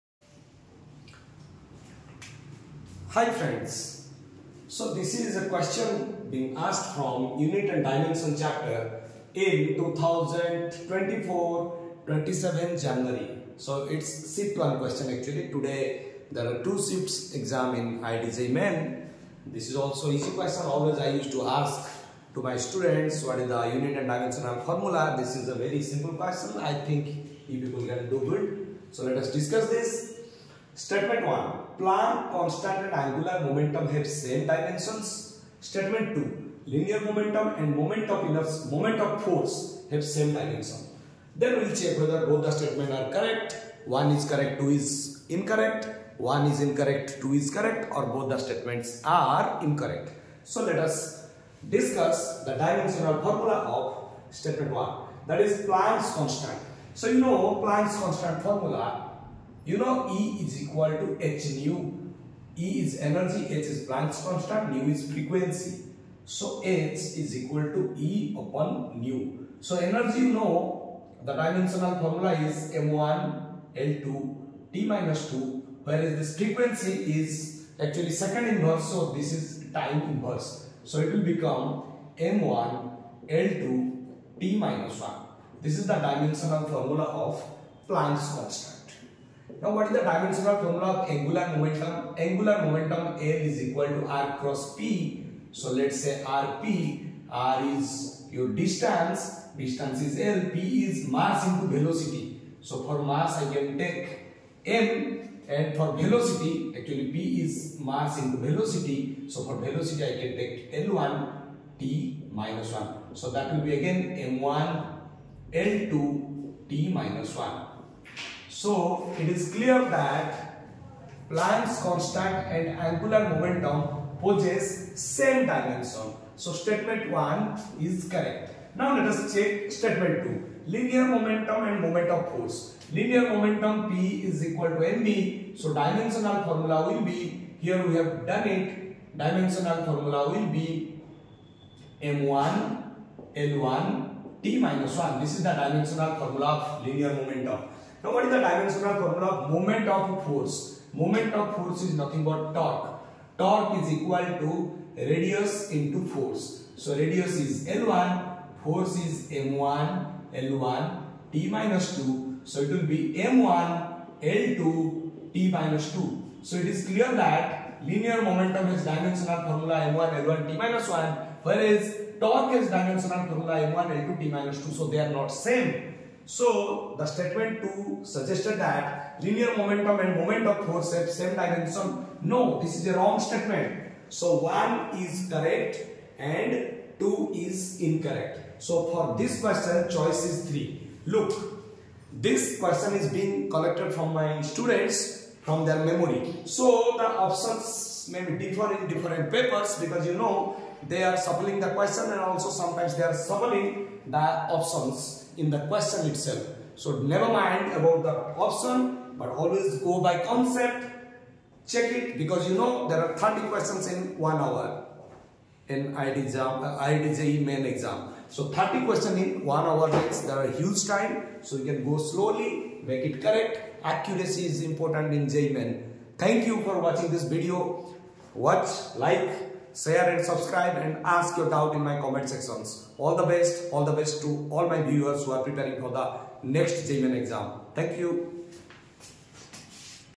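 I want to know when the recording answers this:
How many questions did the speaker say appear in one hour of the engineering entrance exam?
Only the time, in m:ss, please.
3:33.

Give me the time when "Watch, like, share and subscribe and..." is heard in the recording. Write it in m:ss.
3:48.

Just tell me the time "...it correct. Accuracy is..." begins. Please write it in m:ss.
3:43.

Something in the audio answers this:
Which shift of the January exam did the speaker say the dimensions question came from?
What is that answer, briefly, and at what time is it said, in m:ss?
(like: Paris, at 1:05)
Shift 1, at 0:14.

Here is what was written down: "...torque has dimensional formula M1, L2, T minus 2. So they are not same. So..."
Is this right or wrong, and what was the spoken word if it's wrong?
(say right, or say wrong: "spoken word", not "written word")
right.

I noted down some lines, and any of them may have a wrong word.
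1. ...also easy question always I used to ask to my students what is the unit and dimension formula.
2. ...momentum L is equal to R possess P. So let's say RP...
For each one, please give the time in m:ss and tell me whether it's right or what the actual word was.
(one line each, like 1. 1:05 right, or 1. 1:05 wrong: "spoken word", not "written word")
1. 0:19 right
2. 1:32 wrong: "cross", not "possess".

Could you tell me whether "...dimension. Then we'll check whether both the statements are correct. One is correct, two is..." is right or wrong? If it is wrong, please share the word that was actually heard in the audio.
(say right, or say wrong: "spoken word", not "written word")
right.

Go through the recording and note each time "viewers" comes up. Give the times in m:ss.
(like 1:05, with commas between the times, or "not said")
3:54.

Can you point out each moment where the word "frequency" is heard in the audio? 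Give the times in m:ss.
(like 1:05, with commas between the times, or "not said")
1:05, 1:16.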